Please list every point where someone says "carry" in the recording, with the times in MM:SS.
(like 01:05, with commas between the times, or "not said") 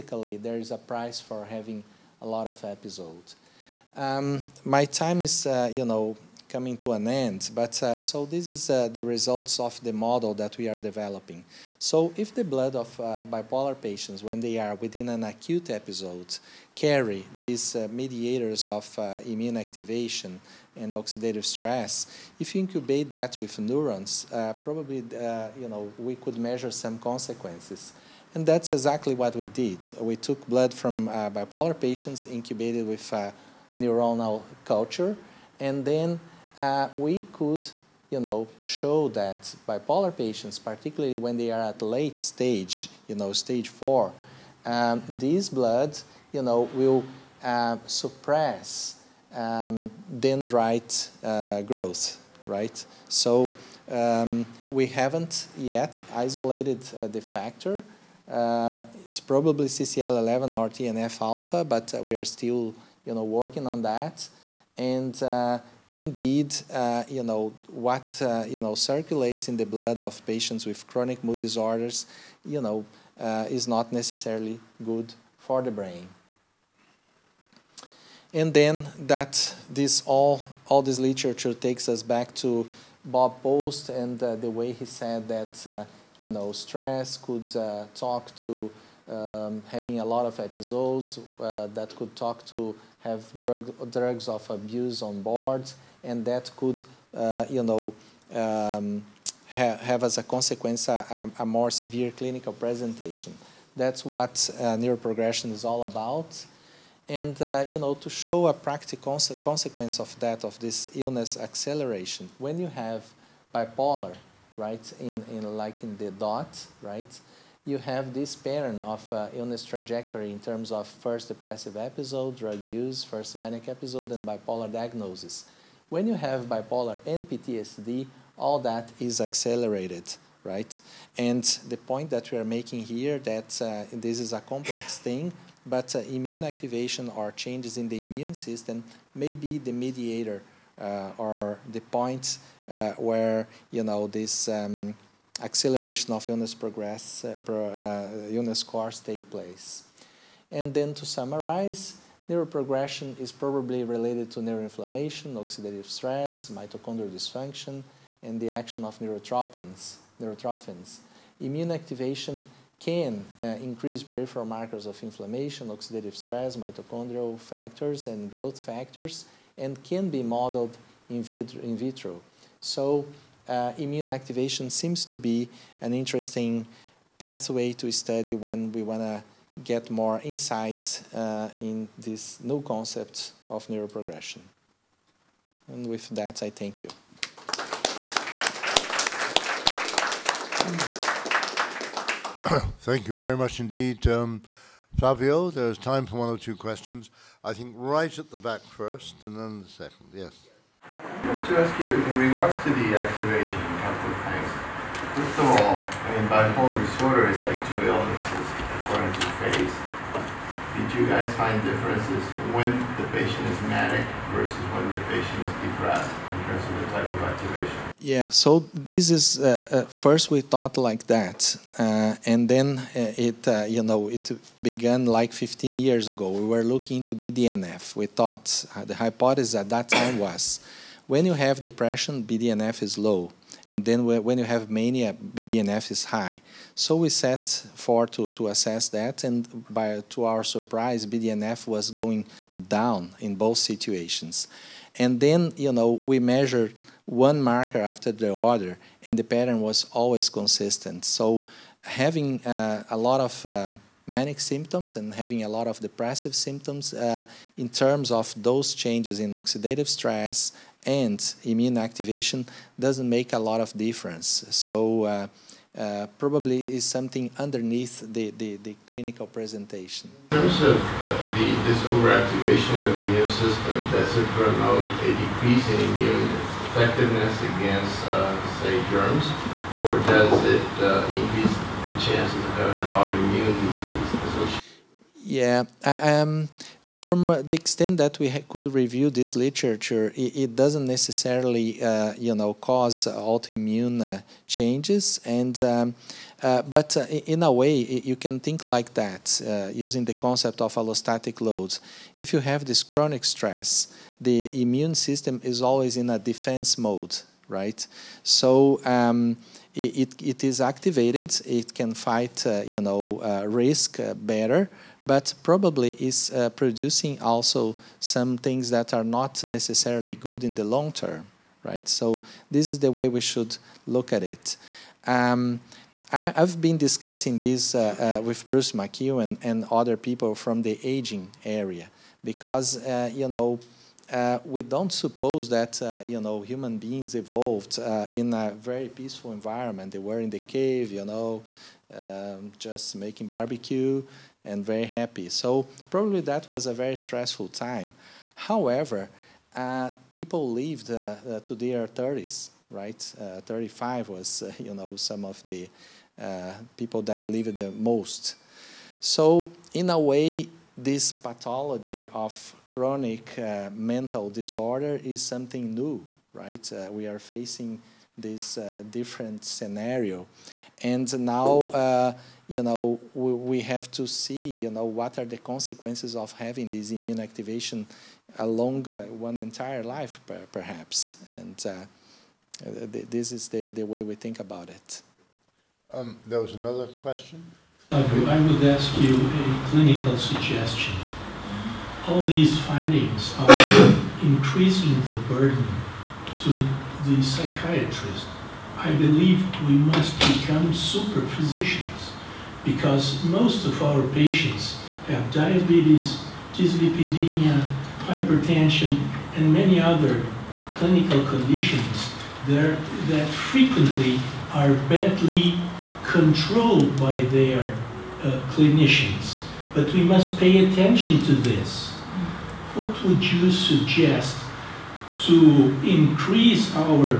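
00:16.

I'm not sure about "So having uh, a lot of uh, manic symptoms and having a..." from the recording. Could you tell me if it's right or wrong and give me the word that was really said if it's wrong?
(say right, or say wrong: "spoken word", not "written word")
right.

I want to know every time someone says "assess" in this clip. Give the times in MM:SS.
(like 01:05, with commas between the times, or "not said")
03:58.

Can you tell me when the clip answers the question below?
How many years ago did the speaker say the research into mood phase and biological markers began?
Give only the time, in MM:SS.
03:45.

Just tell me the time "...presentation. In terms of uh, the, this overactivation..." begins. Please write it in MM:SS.
04:29.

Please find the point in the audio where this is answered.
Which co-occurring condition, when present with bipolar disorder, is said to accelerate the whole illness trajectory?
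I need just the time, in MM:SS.
02:07.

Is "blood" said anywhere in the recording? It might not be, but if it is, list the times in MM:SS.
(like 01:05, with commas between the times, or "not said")
00:12, 00:30, 00:45, 01:09.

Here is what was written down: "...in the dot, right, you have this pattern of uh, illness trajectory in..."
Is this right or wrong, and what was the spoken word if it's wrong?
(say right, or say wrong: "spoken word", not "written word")
right.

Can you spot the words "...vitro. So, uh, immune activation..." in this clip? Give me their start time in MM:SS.
02:51.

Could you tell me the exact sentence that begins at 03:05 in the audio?
And with that, I thank you.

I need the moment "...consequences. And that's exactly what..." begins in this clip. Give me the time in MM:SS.
00:27.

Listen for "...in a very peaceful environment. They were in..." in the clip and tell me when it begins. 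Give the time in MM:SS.
05:38.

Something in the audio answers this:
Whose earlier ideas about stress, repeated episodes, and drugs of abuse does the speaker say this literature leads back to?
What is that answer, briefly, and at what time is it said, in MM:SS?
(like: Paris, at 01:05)
Bob Post, at 01:23.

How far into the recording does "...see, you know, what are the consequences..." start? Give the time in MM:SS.
06:14.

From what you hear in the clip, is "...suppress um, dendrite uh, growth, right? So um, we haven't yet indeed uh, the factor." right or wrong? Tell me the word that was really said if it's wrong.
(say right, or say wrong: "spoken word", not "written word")
wrong: "isolated", not "indeed".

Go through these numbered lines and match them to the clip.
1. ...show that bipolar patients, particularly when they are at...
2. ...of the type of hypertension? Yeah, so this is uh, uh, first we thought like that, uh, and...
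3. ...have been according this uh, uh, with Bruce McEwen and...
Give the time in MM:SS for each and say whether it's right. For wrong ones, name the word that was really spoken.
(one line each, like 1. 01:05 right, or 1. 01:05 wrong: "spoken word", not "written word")
1. 00:38 right
2. 03:36 wrong: "activation", not "hypertension"
3. 05:26 wrong: "discussing", not "according".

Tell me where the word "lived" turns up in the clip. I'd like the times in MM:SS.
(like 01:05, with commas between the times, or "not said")
05:50, 05:57.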